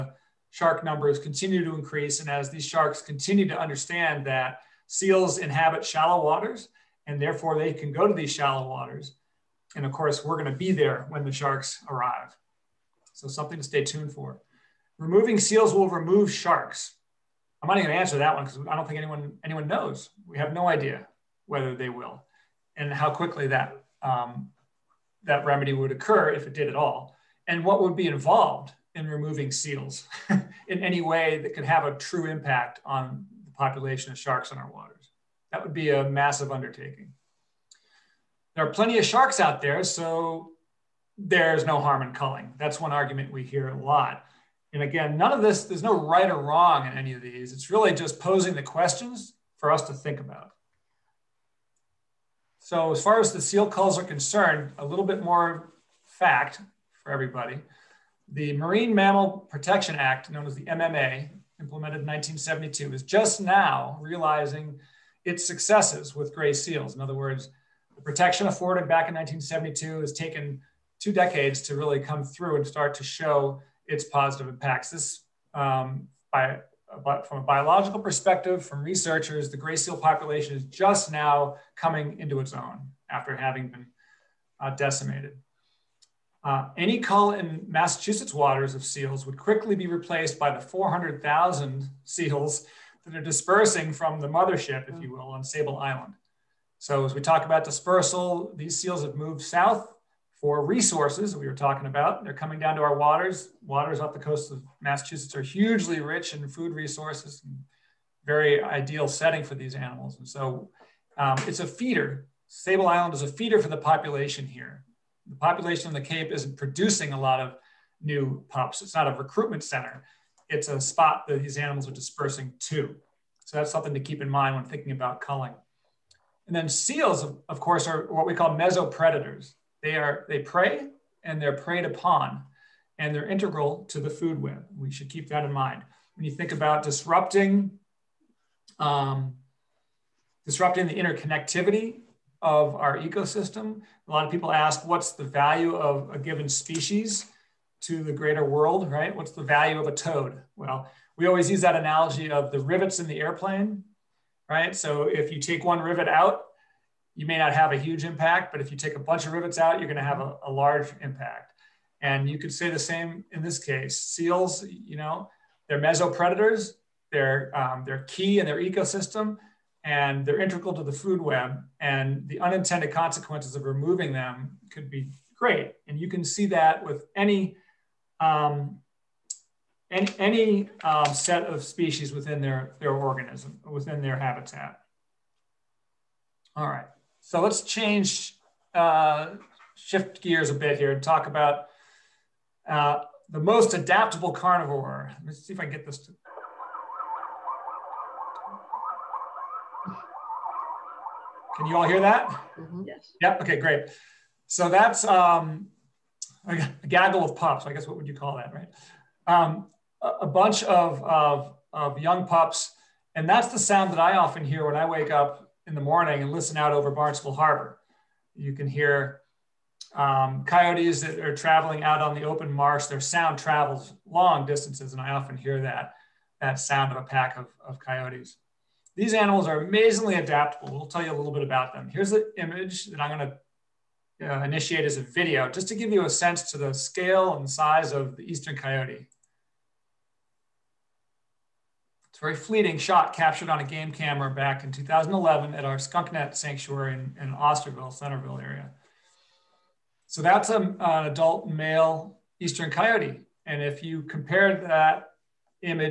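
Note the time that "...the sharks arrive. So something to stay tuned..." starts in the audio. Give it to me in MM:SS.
00:11.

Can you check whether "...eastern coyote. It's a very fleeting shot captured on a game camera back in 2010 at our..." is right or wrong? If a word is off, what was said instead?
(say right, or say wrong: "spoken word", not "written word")
wrong: "2011", not "2010".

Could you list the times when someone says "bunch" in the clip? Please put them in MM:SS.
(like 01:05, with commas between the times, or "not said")
02:38, 03:30.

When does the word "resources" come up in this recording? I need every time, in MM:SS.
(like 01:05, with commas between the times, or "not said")
01:40, 01:46.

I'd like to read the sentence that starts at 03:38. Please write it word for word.
You can hear um, coyotes that are traveling out on the open marsh.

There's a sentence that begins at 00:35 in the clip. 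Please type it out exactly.
That would be a massive undertaking.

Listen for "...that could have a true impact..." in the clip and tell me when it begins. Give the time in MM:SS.
00:31.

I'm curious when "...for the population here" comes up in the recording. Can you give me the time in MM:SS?
01:53.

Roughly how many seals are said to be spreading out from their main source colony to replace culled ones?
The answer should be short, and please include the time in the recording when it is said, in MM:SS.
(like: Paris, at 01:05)
400,000, at 01:30.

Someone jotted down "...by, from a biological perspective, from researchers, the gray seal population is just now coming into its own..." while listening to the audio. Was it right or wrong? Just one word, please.
right.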